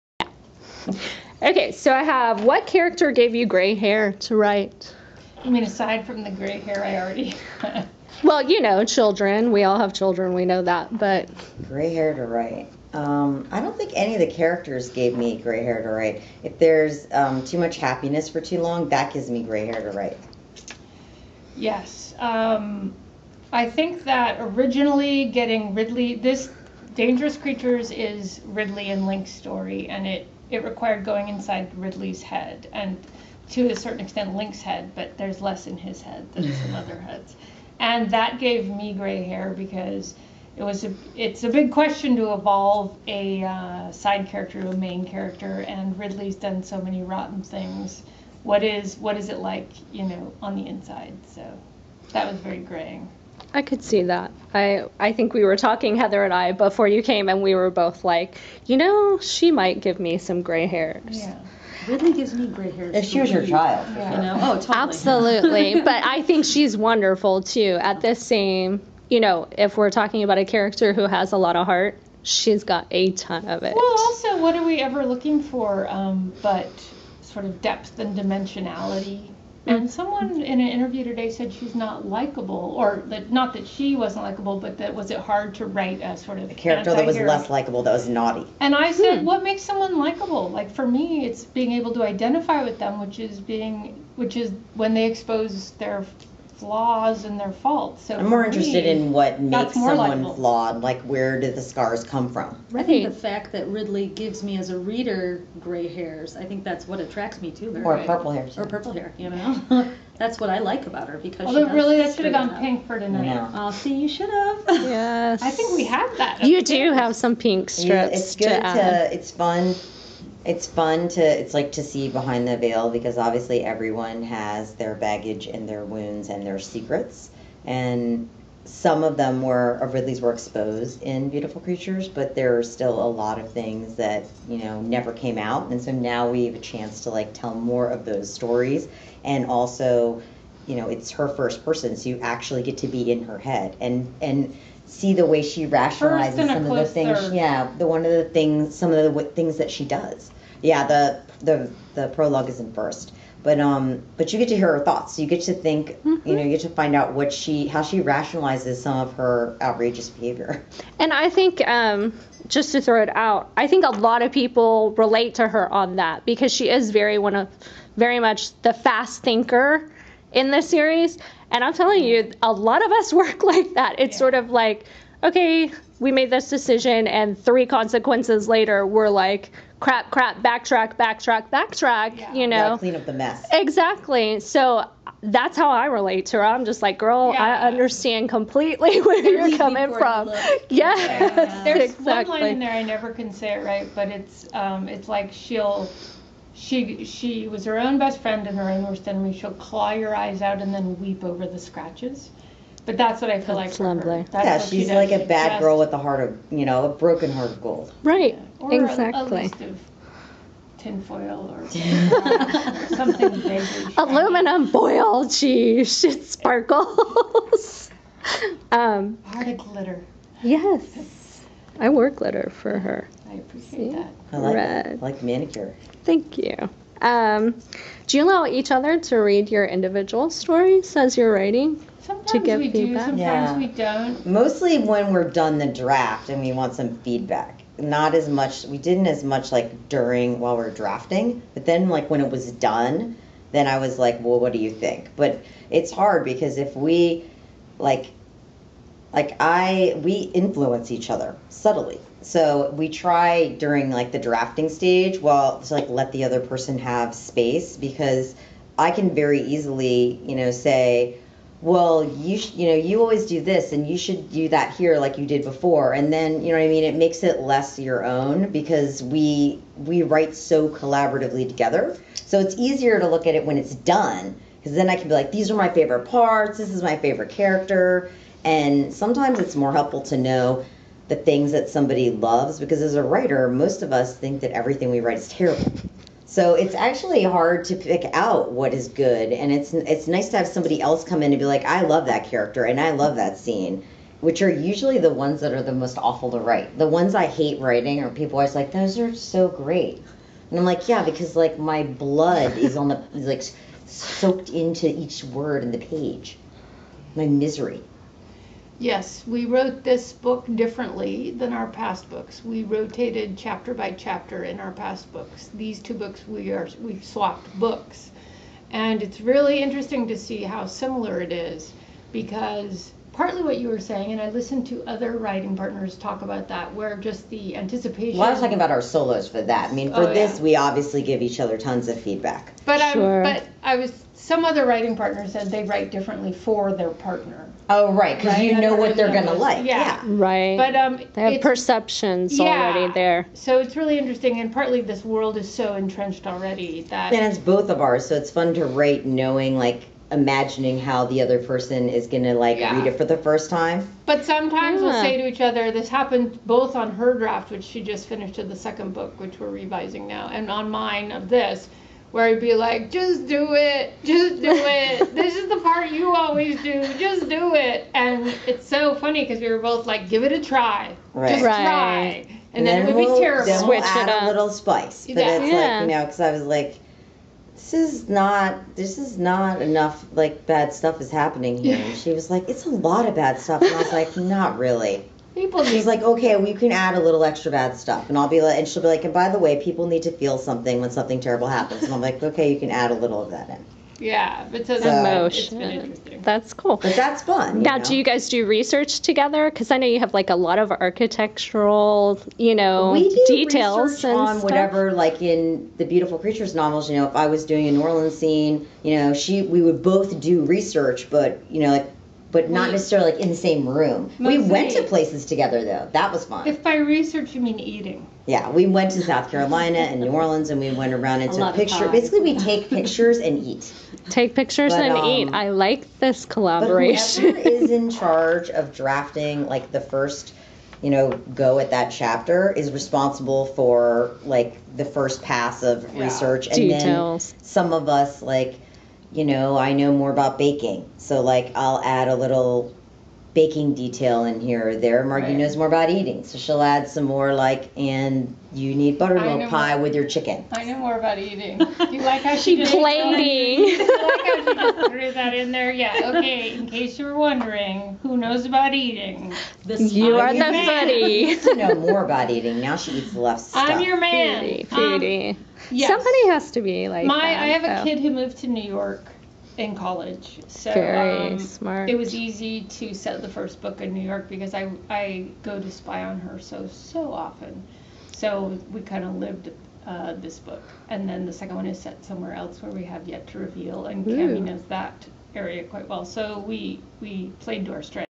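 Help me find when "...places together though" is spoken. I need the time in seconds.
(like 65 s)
414 s.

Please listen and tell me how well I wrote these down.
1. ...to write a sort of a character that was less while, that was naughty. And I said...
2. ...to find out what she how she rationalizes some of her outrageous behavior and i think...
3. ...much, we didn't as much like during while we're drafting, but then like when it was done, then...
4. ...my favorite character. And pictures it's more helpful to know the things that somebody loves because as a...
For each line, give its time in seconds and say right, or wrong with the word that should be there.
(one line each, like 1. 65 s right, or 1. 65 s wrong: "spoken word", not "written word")
1. 85 s wrong: "likable", not "while"
2. 156 s right
3. 238 s right
4. 276 s wrong: "sometimes", not "pictures".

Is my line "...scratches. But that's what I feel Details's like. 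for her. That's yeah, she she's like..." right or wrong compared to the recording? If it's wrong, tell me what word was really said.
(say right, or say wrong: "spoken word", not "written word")
wrong: "That", not "Details".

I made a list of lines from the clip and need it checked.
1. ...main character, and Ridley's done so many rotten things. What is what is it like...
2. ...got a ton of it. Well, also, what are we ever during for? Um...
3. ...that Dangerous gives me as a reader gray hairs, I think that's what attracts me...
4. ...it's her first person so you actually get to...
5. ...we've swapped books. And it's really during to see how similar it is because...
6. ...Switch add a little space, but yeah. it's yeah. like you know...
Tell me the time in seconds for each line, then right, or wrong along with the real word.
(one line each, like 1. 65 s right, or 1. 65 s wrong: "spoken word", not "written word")
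1. 44 s right
2. 72 s wrong: "looking", not "during"
3. 103 s wrong: "Ridley", not "Dangerous"
4. 140 s right
5. 316 s wrong: "interesting", not "during"
6. 373 s wrong: "spice", not "space".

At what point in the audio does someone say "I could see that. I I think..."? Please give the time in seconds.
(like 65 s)
53 s.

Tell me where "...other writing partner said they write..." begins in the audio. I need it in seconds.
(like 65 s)
334 s.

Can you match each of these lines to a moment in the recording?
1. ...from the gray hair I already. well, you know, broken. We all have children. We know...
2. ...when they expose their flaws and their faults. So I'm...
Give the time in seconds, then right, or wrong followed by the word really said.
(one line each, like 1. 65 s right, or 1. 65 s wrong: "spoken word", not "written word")
1. 6 s wrong: "children", not "broken"
2. 94 s right.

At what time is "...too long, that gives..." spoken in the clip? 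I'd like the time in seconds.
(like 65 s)
18 s.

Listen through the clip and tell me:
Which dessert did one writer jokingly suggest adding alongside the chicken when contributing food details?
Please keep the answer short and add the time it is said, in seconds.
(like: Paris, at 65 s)
buttermilk pie, at 448 s.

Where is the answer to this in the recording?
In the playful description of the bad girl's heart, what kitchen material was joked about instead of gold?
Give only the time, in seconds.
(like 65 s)
213 s.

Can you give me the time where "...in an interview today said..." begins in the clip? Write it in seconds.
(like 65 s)
80 s.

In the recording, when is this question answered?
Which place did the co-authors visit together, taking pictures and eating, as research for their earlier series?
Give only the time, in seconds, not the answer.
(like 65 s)
419 s.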